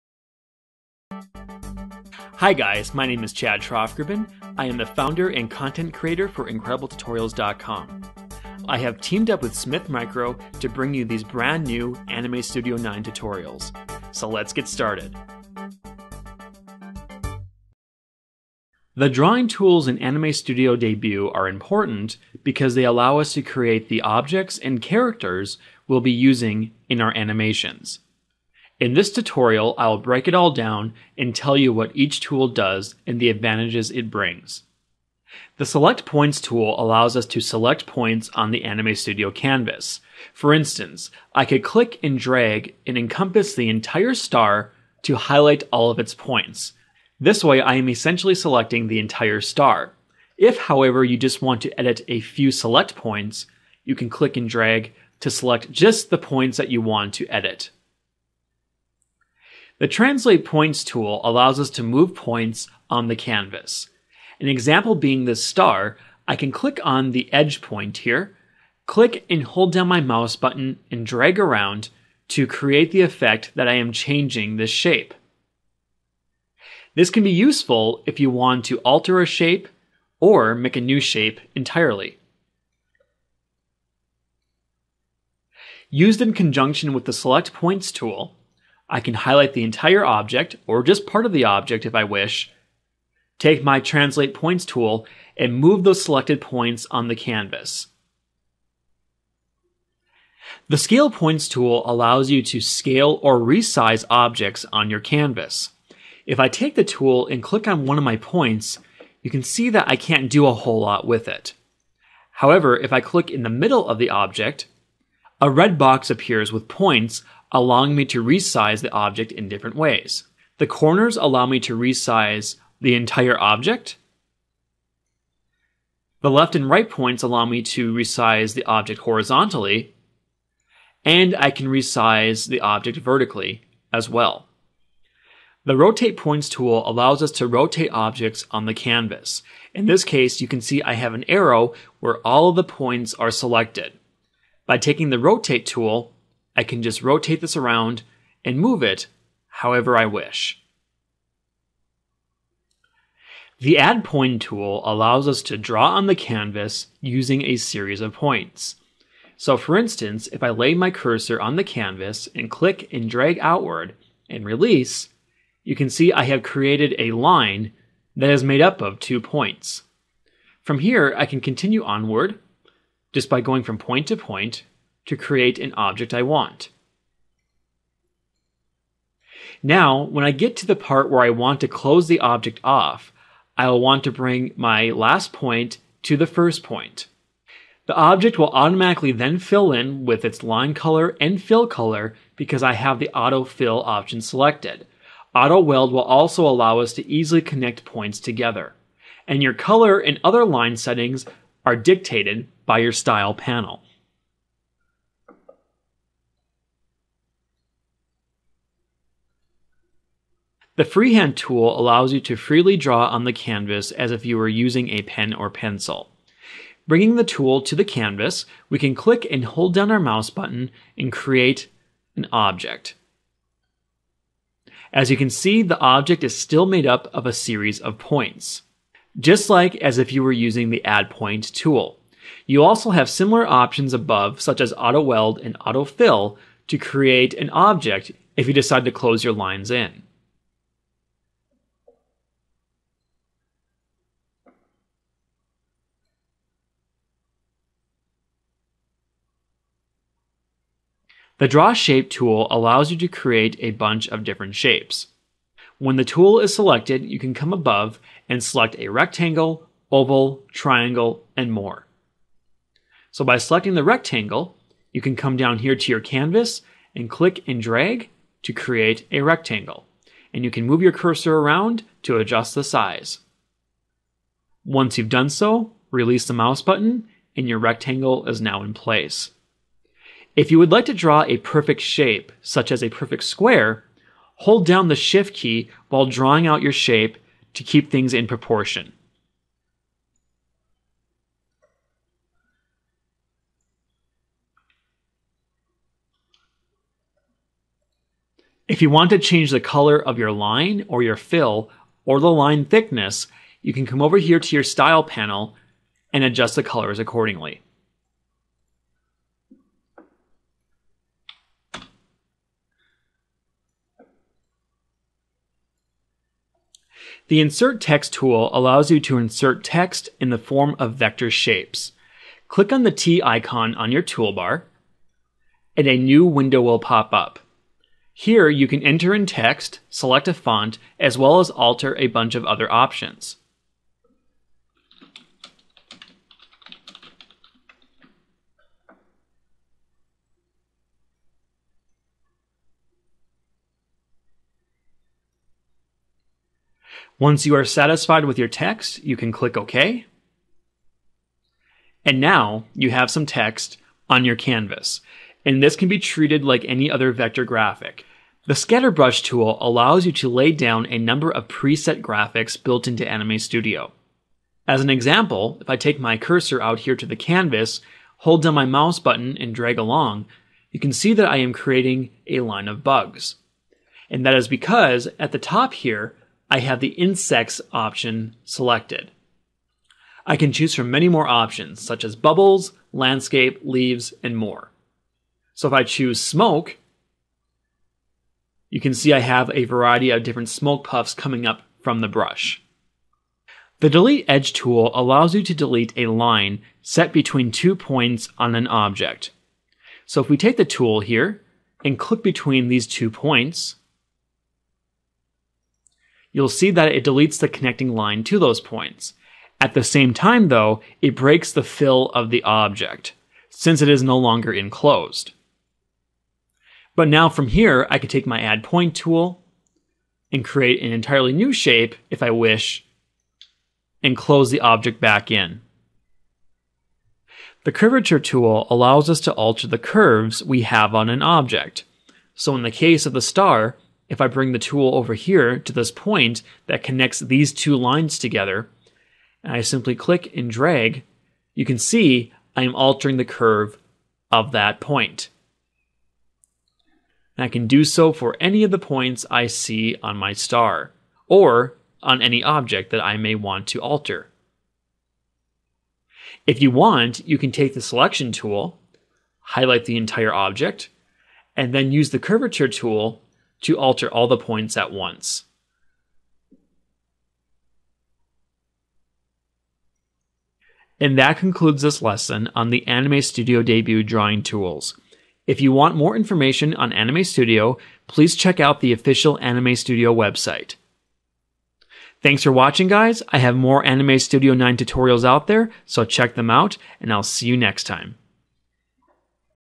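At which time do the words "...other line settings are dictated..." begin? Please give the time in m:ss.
3:20.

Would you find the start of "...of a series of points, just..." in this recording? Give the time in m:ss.
3:47.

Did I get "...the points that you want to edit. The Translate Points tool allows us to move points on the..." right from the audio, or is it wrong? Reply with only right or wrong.
right.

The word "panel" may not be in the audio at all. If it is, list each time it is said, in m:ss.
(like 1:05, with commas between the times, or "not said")
3:23, 5:05.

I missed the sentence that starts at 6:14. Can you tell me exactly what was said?
And that is because at the top here, I have the insects option selected.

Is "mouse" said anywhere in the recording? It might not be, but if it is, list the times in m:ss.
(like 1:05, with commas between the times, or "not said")
1:09, 3:39, 4:36, 6:08.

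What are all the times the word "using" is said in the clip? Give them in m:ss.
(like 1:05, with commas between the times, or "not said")
0:26, 2:36, 3:34, 3:50.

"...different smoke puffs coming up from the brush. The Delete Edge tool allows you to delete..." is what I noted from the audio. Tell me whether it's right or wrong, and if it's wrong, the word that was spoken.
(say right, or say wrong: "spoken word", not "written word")
right.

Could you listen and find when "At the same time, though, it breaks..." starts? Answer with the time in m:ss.
6:49.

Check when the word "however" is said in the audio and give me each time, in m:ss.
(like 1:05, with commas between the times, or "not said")
0:50, 1:52, 2:29.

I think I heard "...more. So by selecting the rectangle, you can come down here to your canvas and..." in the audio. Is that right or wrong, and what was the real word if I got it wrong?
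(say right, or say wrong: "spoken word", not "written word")
right.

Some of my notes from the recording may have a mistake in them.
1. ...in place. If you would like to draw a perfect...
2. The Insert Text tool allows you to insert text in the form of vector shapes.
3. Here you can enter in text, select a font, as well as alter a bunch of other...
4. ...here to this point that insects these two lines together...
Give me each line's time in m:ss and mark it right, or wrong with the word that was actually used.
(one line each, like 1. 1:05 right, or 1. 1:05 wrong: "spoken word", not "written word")
1. 4:38 right
2. 5:17 right
3. 5:28 right
4. 7:15 wrong: "connects", not "insects".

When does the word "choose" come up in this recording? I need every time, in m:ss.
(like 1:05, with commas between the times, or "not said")
6:20, 6:25.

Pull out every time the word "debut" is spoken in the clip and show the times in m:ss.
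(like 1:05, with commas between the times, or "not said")
0:20, 7:53.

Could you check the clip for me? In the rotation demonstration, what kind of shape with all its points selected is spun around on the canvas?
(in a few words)
An arrow.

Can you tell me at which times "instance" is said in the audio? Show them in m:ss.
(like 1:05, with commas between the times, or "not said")
0:40, 2:39.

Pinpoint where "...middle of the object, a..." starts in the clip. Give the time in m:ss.
1:53.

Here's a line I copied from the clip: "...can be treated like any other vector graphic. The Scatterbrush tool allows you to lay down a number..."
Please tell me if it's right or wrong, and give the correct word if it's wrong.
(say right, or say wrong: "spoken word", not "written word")
right.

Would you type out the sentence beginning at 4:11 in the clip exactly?
The Draw Shape tool allows you to create a bunch of different shapes.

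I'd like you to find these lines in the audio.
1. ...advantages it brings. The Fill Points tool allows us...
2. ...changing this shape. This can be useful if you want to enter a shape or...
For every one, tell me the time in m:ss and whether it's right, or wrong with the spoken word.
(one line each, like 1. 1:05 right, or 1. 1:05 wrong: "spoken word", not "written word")
1. 0:33 wrong: "Select", not "Fill"
2. 1:13 wrong: "alter", not "enter".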